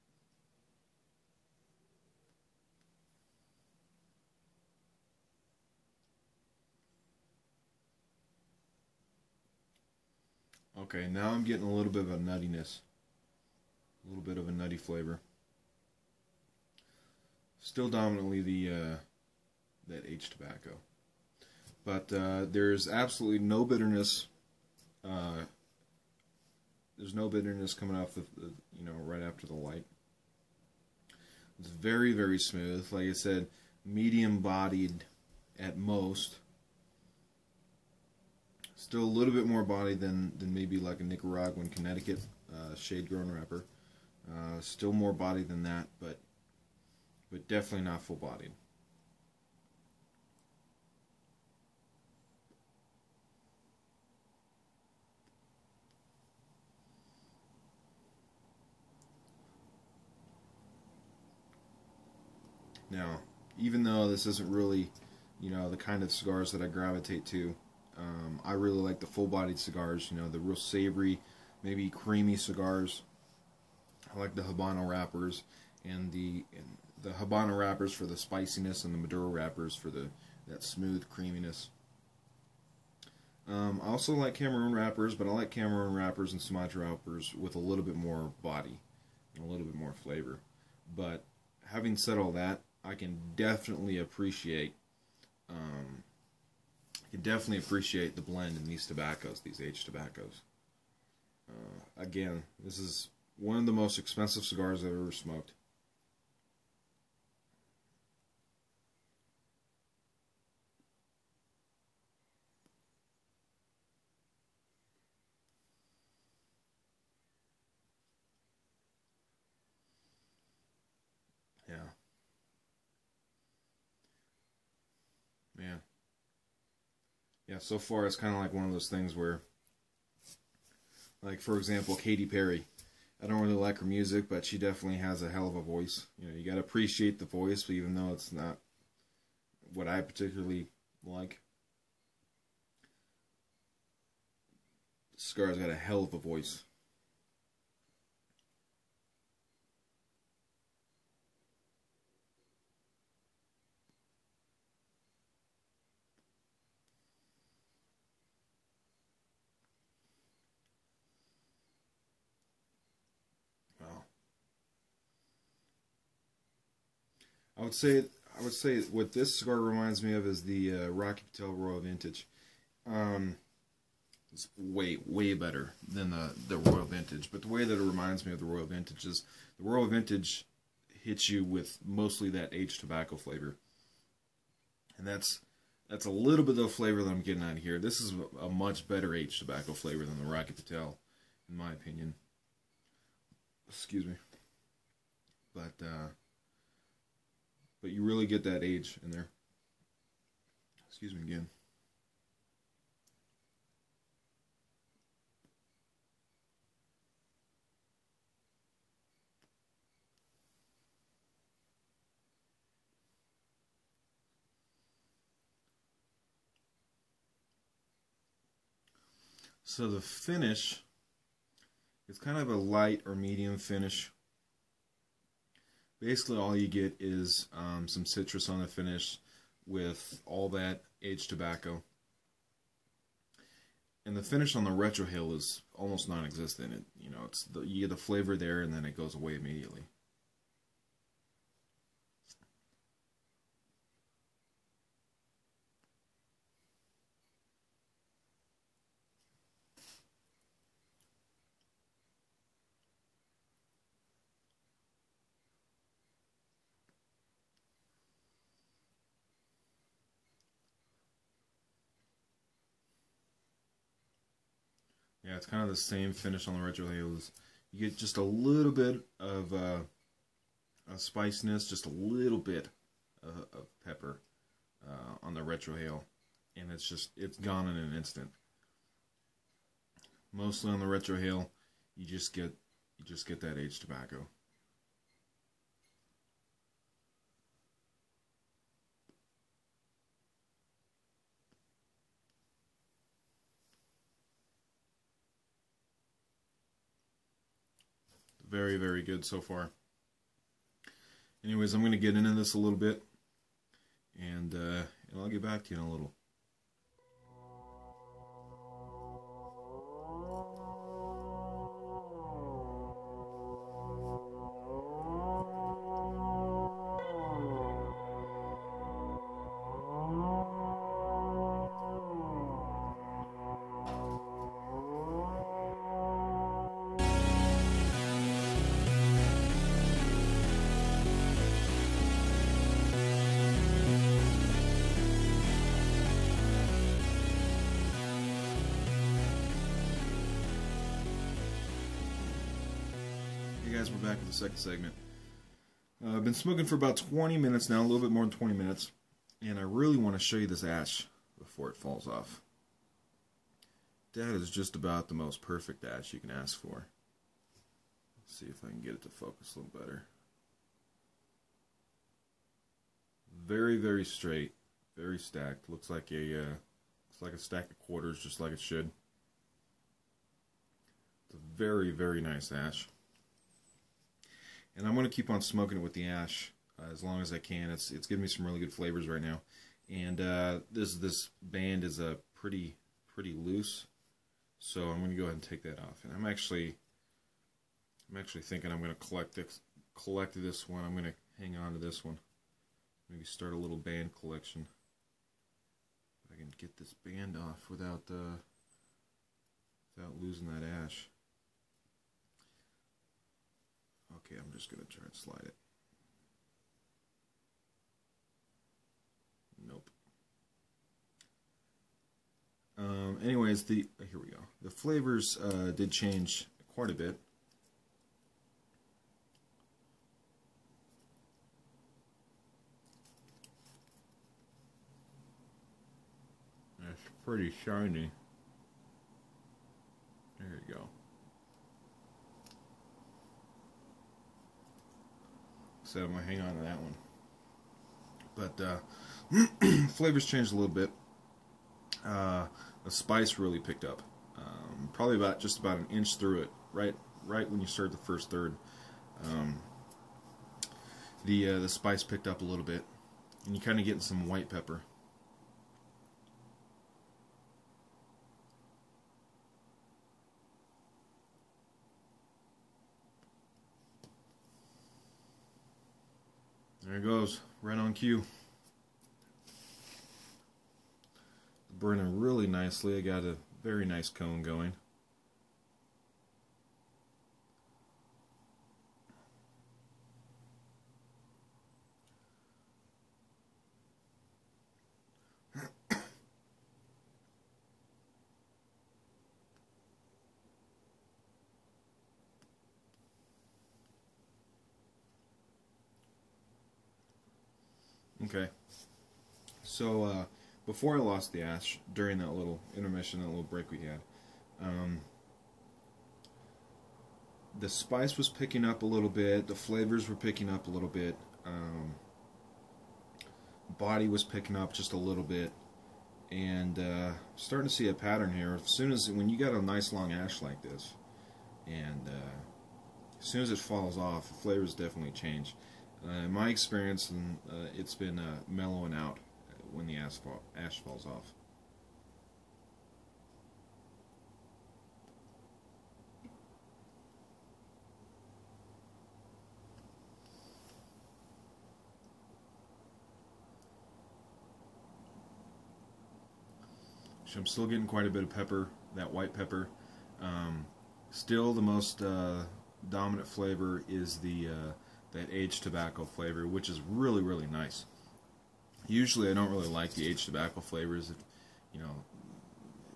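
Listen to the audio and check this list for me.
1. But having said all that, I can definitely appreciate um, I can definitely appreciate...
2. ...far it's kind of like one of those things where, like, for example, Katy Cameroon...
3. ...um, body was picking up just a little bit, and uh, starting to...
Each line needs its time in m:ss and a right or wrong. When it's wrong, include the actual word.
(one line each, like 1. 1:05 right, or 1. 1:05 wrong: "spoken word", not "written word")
1. 1:30 right
2. 2:07 wrong: "Perry", not "Cameroon"
3. 8:31 right.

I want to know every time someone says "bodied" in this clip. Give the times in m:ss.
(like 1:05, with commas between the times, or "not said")
0:34, 0:48, 1:09.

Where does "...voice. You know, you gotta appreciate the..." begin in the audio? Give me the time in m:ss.
2:15.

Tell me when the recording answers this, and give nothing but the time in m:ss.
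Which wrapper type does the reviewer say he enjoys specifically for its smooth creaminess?
1:18.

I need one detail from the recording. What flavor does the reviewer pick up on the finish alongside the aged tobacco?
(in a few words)
Citrus.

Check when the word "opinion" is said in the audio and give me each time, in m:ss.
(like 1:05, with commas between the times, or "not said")
3:11.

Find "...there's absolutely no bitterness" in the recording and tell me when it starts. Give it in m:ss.
0:22.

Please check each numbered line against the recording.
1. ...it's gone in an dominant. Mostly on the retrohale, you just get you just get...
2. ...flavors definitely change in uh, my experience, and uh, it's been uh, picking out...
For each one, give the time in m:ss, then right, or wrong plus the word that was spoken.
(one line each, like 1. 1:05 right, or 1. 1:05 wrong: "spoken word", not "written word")
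1. 4:37 wrong: "instant", not "dominant"
2. 8:44 wrong: "mellowing", not "picking".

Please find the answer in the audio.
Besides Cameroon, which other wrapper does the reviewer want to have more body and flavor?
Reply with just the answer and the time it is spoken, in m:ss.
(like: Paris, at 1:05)
Sumatra, at 1:26.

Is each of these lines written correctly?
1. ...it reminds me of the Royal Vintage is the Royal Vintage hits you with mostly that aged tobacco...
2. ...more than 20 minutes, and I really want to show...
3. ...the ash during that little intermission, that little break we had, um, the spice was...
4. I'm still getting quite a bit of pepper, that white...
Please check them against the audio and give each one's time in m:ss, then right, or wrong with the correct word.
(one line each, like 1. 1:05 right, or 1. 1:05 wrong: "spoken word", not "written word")
1. 2:57 right
2. 5:48 right
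3. 8:21 right
4. 9:07 right.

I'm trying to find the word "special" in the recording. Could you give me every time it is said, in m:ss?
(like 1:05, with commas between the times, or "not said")
not said.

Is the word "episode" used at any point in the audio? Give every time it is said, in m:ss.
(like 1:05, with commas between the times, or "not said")
not said.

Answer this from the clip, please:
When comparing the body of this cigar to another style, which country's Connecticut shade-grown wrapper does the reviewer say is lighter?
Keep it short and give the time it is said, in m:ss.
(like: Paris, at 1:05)
Nicaraguan, at 0:41.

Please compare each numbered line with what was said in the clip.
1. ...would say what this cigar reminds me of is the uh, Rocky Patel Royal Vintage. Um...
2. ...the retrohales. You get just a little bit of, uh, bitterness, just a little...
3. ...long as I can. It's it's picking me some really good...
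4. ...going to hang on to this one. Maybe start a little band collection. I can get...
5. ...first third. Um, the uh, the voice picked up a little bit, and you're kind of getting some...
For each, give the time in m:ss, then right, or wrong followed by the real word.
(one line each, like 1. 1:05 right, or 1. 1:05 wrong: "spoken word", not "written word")
1. 2:48 right
2. 4:26 wrong: "spiciness", not "bitterness"
3. 6:17 wrong: "giving", not "picking"
4. 6:30 right
5. 7:27 wrong: "spice", not "voice".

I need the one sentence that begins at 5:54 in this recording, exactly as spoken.
That is just about the most perfect ash you can ask for.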